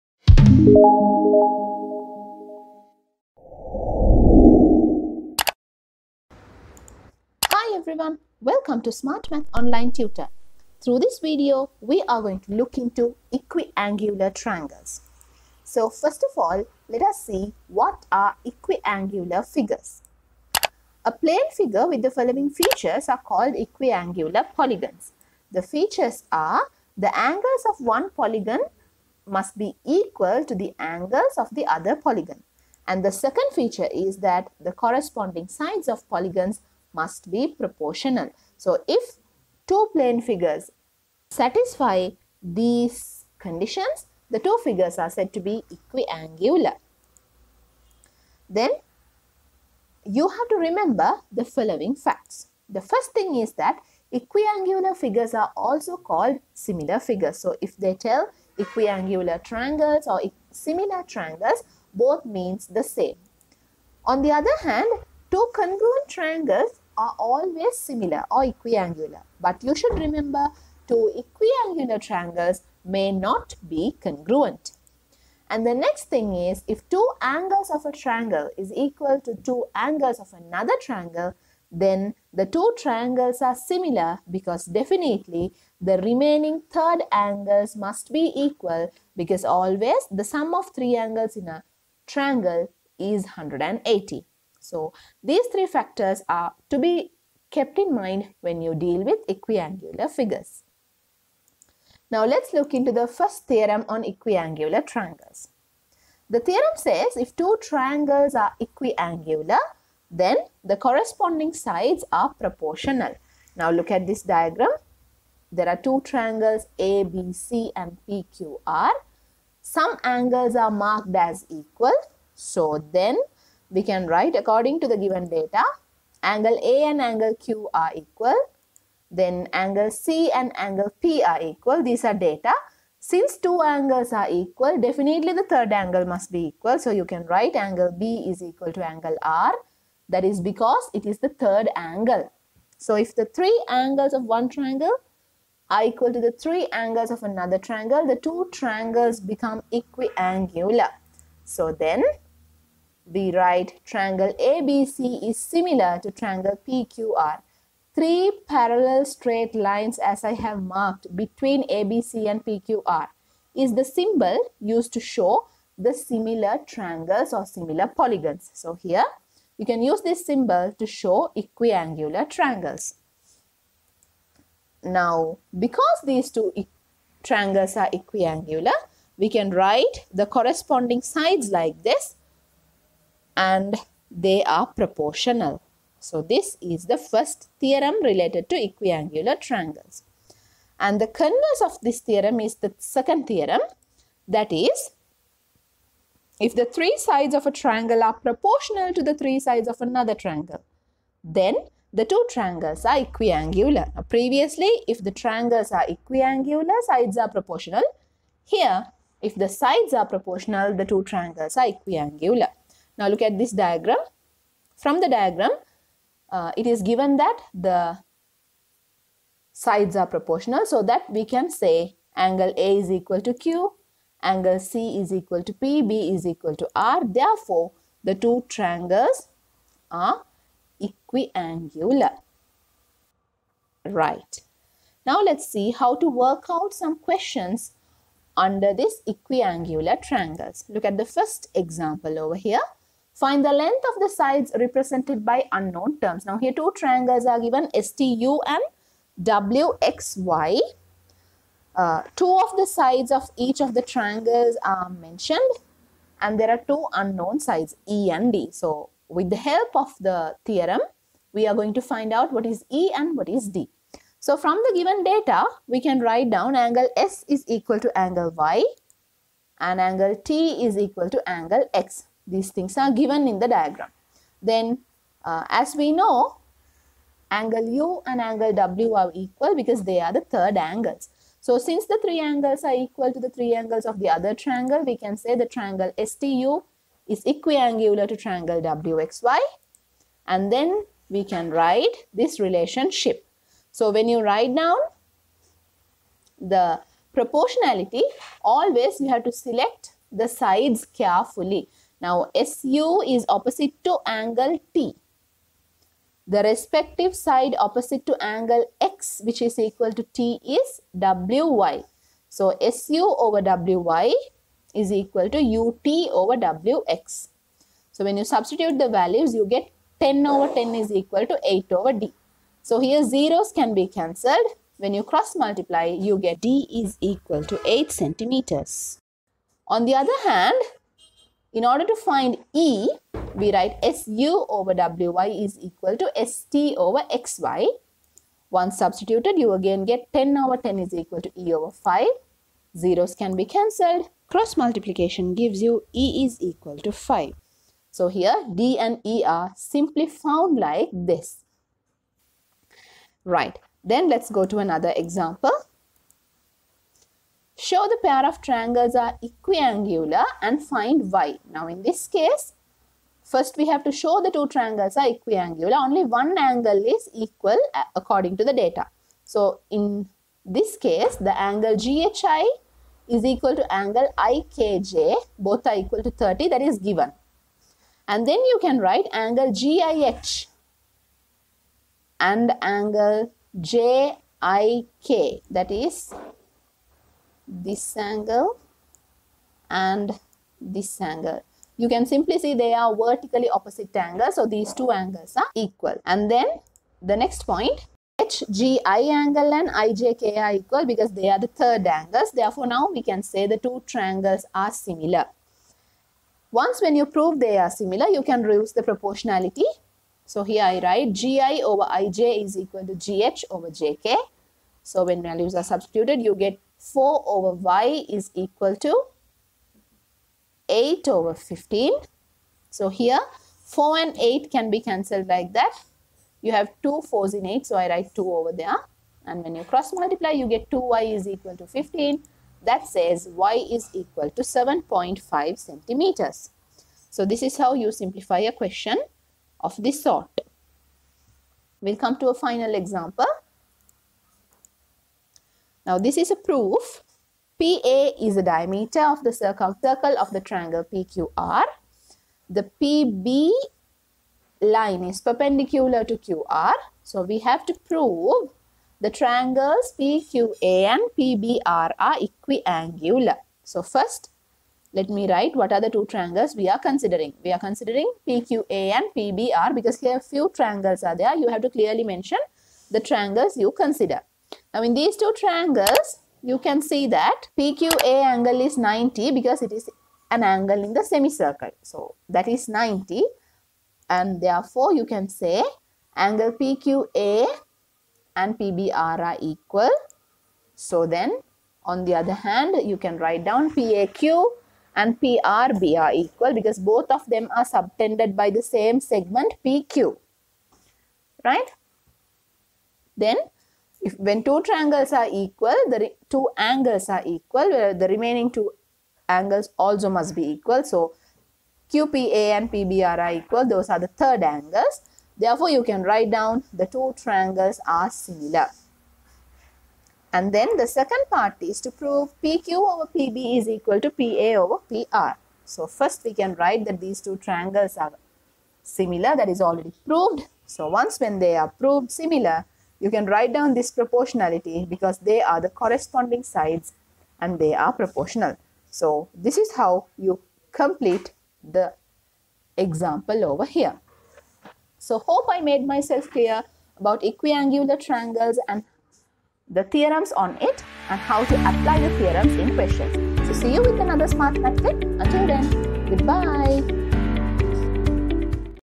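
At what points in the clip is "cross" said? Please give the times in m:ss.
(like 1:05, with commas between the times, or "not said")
5:25, 5:44, 7:09.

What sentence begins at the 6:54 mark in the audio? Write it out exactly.
So when values are substituted, you get 4 over Y is equal to 8 over 15.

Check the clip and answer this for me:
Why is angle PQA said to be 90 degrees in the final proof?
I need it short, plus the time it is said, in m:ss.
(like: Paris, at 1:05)
angle in the semicircle, at 8:00.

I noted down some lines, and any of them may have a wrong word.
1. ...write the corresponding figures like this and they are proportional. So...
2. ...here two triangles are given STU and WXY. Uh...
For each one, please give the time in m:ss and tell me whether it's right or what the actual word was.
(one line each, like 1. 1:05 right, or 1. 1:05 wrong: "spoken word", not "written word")
1. 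2:59 wrong: "sides", not "figures"
2. 4:06 right.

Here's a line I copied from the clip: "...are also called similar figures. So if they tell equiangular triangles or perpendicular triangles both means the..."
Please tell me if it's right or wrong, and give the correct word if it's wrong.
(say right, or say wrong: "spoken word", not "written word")
wrong: "similar", not "perpendicular".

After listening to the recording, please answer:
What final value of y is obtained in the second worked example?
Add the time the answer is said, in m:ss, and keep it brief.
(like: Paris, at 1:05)
7.5 centimeters, at 7:14.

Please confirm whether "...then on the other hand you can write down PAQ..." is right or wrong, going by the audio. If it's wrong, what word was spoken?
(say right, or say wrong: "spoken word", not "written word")
right.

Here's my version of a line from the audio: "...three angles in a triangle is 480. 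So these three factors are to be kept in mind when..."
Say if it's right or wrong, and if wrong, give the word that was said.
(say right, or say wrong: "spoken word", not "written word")
wrong: "180", not "480".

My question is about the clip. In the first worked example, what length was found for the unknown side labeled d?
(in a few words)
8 centimeters.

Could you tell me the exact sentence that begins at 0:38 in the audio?
So if two plane figures satisfy these conditions, the two figures are said to be equiangular.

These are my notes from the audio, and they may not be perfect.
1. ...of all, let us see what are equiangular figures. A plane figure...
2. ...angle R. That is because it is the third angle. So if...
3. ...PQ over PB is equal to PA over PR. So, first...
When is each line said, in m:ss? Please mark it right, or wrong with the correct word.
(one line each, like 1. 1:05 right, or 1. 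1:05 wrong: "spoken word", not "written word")
1. 0:16 right
2. 2:18 right
3. 8:42 right.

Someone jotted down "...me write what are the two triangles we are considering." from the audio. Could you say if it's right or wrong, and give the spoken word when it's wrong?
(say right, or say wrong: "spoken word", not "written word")
right.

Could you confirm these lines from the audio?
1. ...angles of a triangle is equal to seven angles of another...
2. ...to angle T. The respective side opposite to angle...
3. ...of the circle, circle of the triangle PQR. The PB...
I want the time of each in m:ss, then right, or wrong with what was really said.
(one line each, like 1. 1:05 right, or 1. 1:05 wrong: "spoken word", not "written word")
1. 1:17 wrong: "two", not "seven"
2. 5:03 right
3. 7:29 right.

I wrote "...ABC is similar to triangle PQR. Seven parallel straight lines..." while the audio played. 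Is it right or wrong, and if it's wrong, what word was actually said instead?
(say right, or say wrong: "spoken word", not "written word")
wrong: "Three", not "Seven".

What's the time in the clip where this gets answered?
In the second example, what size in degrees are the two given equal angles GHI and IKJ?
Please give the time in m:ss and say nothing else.
6:15.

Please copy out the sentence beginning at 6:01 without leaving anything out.
Now in this case, first we have to show the two triangles are equiangular.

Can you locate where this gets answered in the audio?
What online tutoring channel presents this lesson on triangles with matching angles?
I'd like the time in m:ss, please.
0:08.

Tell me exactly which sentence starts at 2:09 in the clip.
Then angle C and angle P are equal.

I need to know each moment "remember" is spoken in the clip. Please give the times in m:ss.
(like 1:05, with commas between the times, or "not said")
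0:50, 1:09.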